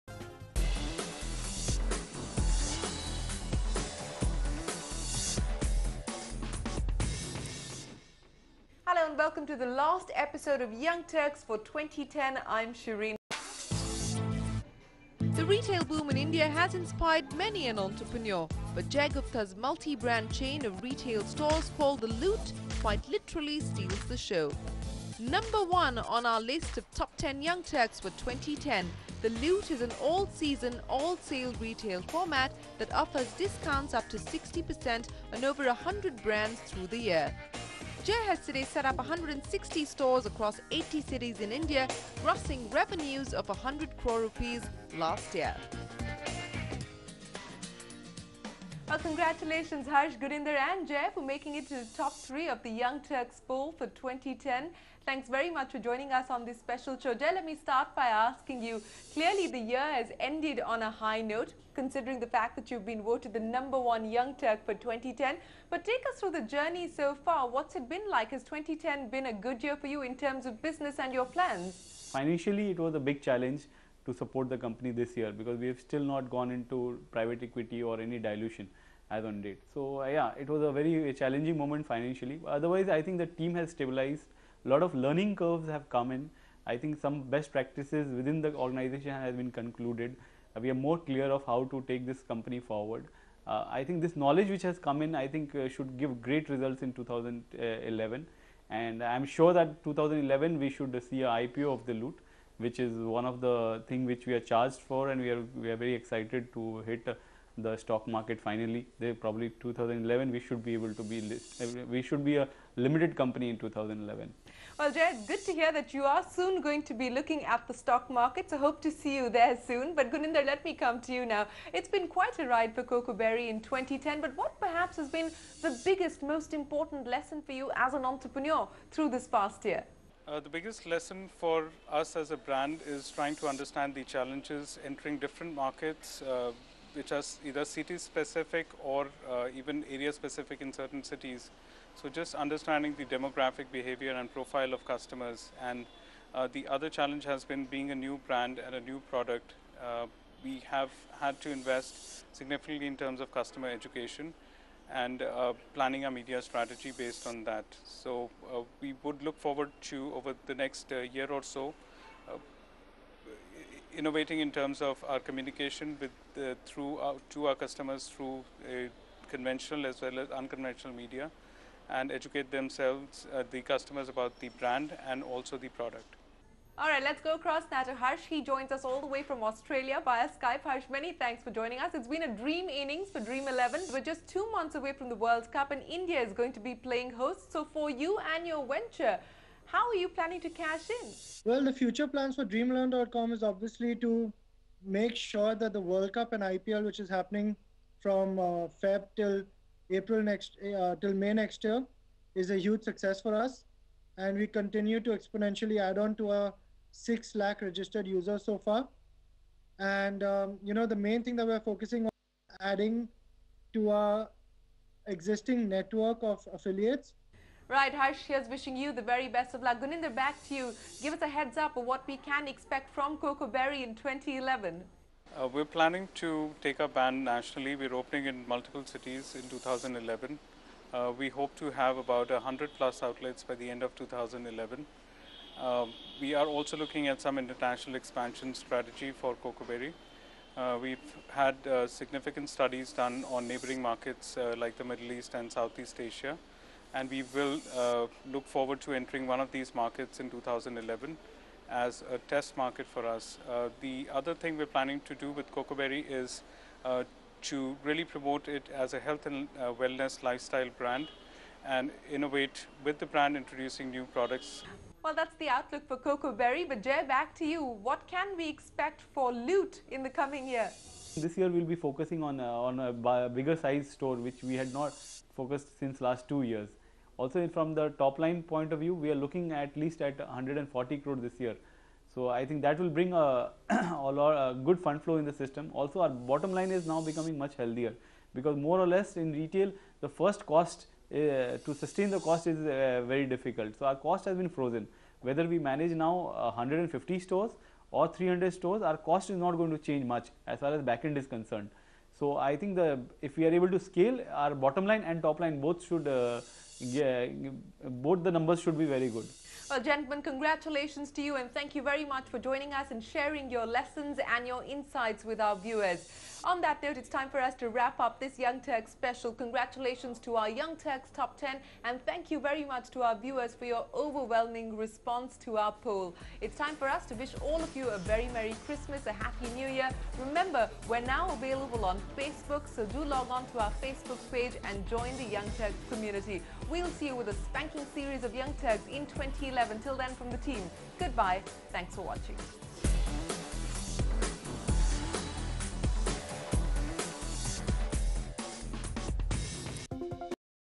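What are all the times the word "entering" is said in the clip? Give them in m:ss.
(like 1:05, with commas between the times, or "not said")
2:14, 4:08.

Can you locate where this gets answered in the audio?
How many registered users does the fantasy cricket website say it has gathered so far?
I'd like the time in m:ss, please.
3:26.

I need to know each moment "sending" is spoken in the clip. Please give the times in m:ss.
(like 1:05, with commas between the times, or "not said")
not said.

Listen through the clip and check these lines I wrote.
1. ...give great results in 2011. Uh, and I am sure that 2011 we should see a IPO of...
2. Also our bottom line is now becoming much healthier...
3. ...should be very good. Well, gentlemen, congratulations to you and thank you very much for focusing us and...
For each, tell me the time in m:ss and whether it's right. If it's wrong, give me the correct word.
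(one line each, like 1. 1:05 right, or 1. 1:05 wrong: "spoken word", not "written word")
1. 1:35 right
2. 4:45 right
3. 5:08 wrong: "joining", not "focusing".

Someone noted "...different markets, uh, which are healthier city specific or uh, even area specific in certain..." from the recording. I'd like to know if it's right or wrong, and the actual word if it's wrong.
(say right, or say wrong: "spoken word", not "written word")
wrong: "either", not "healthier".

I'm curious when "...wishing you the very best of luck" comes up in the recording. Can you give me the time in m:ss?
3:38.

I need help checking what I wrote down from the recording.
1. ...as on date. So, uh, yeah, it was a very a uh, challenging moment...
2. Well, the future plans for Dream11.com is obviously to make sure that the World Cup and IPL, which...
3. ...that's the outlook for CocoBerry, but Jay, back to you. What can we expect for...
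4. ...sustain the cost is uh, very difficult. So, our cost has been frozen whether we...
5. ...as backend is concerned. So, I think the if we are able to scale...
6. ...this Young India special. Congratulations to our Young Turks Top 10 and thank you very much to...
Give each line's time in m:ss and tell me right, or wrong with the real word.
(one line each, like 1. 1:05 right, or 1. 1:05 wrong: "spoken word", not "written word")
1. 1:19 right
2. 3:11 right
3. 4:25 right
4. 4:51 right
5. 5:00 right
6. 5:18 wrong: "Turks", not "India".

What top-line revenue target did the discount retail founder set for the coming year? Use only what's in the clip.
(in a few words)
140 crore.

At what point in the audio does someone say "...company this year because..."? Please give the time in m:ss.
1:14.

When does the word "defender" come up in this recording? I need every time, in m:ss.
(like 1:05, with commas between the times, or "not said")
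not said.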